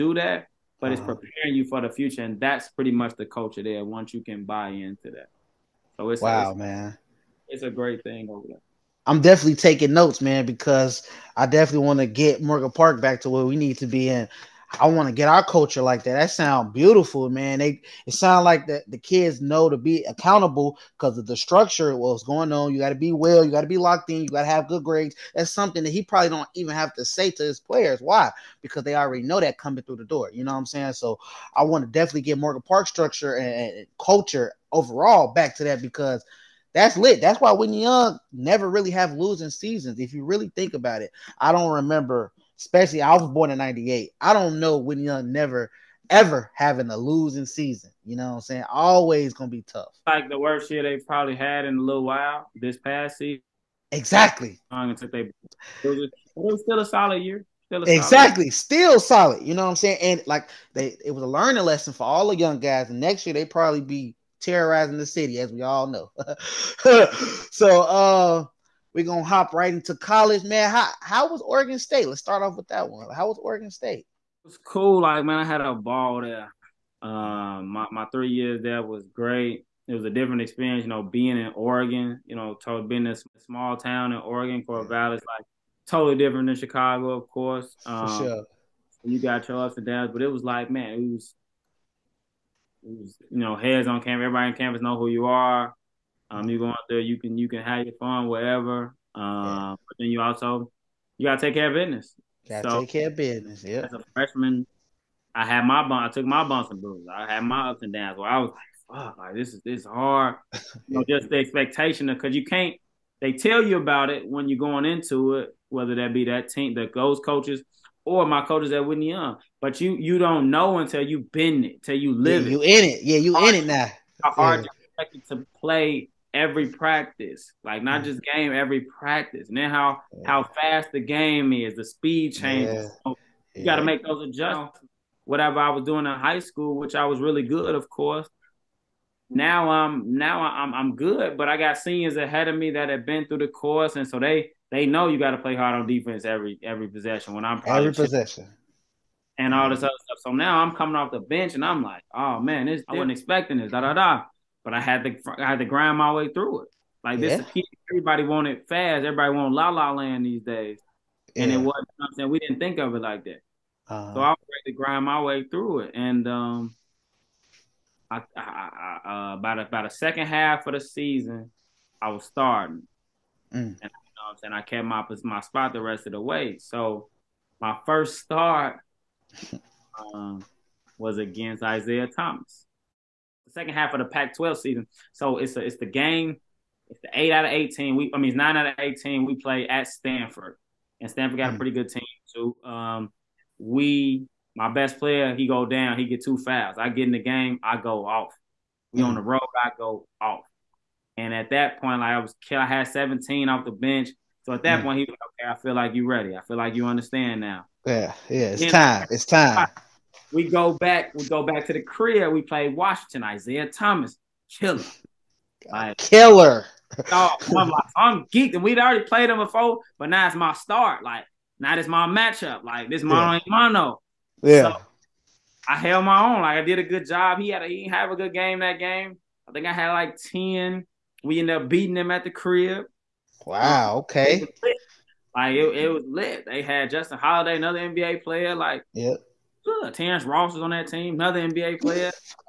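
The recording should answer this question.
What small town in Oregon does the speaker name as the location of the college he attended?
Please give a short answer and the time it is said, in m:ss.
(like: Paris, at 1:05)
Corvallis, at 1:24.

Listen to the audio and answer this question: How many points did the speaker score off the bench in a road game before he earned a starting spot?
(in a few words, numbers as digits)
17.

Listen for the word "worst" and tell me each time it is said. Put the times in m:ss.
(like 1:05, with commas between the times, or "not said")
0:50.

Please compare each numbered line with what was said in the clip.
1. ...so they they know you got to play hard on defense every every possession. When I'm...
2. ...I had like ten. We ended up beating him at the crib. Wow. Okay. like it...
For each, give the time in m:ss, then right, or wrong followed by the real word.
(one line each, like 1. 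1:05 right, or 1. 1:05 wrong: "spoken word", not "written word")
1. 2:24 right
2. 3:49 right.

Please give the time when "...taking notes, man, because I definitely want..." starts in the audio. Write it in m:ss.
0:09.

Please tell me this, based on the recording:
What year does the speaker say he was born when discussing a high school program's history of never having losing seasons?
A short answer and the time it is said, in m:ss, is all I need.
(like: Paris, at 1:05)
1998, at 0:43.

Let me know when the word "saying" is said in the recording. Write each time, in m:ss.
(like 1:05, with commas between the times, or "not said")
0:30, 0:48, 0:59, 2:54.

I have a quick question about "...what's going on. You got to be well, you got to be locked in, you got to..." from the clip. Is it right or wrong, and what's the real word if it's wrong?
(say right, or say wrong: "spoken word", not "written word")
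right.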